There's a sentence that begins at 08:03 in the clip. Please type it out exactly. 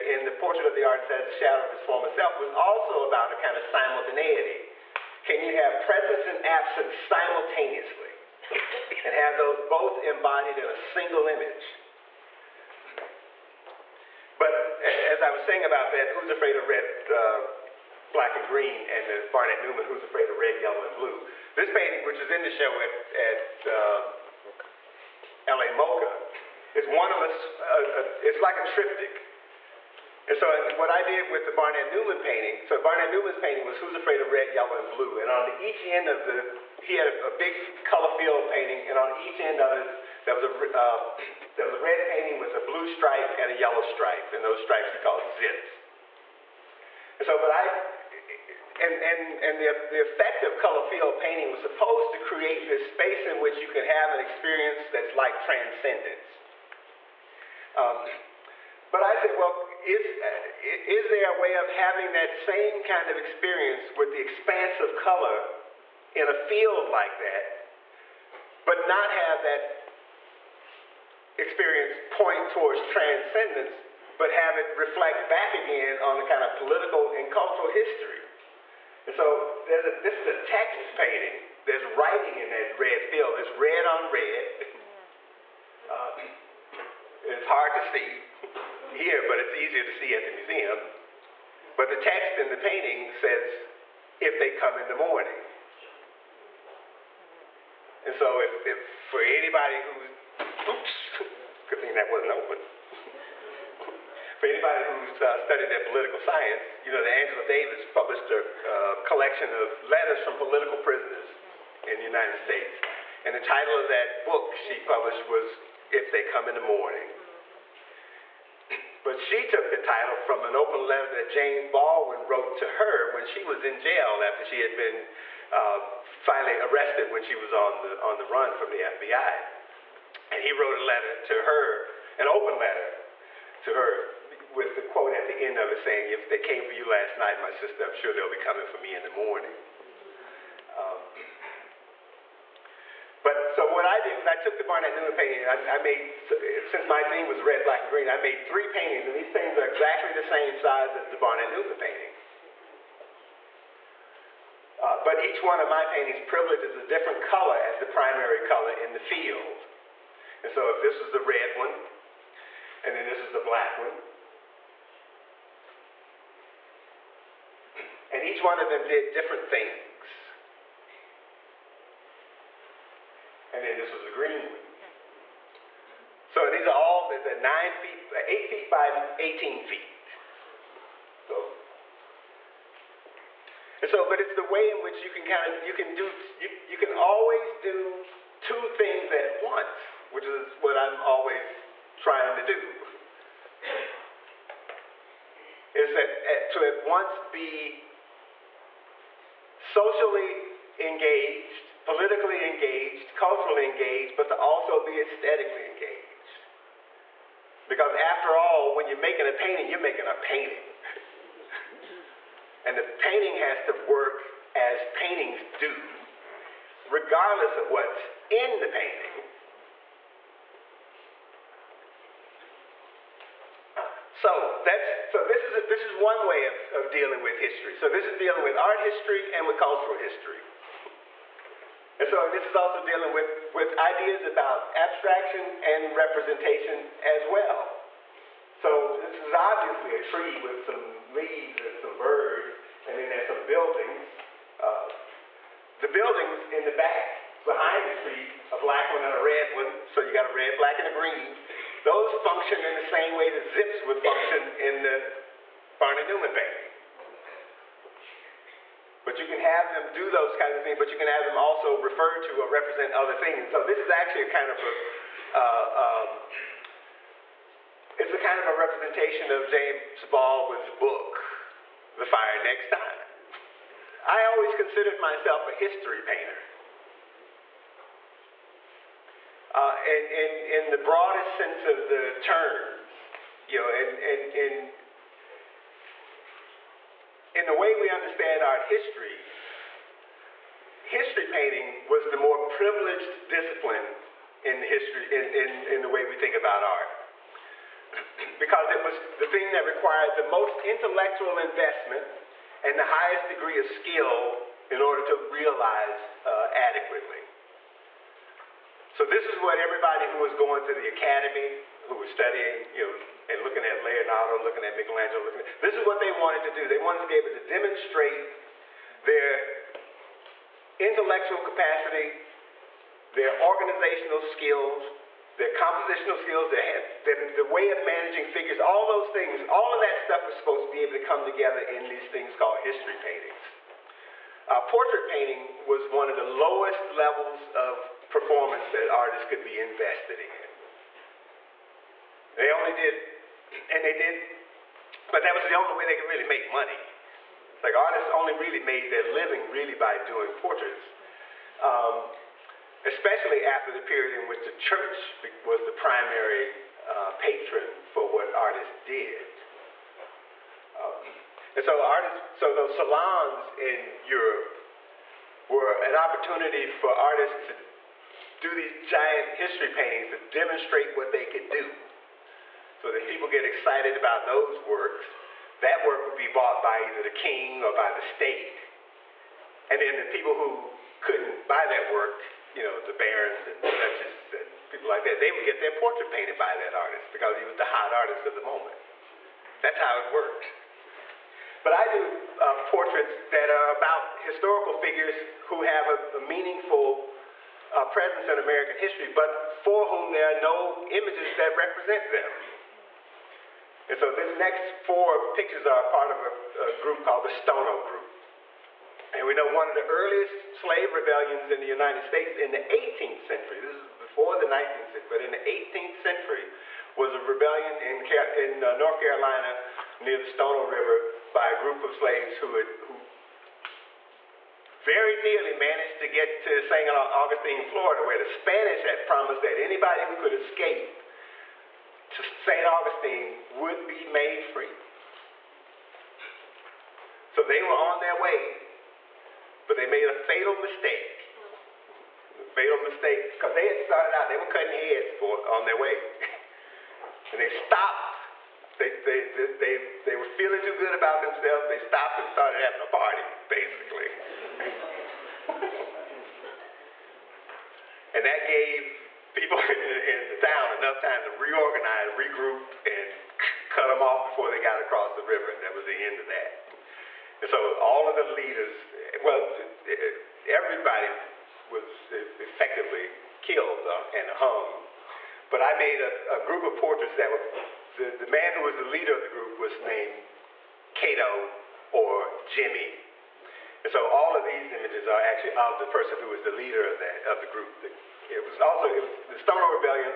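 And so all of these images are actually of the person who was the leader of that of the group.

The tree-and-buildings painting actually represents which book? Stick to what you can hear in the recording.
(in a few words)
The Fire Next Time.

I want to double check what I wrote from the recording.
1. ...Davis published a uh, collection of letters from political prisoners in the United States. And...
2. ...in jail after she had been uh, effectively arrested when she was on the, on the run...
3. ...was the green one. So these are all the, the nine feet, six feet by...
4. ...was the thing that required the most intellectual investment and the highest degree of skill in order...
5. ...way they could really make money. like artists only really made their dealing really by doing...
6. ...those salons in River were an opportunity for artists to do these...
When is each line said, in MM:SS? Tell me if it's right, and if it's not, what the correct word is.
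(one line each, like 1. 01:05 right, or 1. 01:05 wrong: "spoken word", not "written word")
1. 01:47 right
2. 02:03 wrong: "finally", not "effectively"
3. 02:53 wrong: "eight", not "six"
4. 04:58 right
5. 05:45 wrong: "living", not "dealing"
6. 06:02 wrong: "Europe", not "River".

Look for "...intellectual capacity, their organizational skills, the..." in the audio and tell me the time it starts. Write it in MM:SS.
05:20.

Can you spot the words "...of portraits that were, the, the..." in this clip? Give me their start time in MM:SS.
07:56.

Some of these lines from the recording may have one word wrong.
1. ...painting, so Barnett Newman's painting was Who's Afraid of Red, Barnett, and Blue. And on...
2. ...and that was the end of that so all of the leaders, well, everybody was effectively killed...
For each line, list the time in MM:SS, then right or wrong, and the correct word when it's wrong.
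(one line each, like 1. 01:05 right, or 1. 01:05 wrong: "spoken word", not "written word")
1. 00:32 wrong: "Yellow", not "Barnett"
2. 07:45 right.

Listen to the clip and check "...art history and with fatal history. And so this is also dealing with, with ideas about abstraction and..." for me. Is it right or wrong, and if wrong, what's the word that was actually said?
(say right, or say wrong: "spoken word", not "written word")
wrong: "cultural", not "fatal".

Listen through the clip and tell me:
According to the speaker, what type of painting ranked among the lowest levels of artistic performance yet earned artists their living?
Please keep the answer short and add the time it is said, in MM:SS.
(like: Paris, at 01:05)
portrait painting, at 05:34.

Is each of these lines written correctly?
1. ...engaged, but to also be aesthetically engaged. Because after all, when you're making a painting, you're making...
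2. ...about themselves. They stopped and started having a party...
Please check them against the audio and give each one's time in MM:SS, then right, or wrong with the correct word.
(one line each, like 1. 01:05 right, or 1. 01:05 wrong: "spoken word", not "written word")
1. 03:23 right
2. 07:30 right.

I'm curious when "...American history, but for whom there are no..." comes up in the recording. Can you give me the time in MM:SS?
06:38.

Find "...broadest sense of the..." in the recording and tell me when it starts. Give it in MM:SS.
04:40.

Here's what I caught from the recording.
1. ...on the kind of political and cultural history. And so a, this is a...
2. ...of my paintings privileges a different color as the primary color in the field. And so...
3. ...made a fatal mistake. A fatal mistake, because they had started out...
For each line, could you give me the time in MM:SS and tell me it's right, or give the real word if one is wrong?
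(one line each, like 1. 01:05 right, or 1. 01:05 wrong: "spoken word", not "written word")
1. 01:15 right
2. 02:35 right
3. 07:19 right.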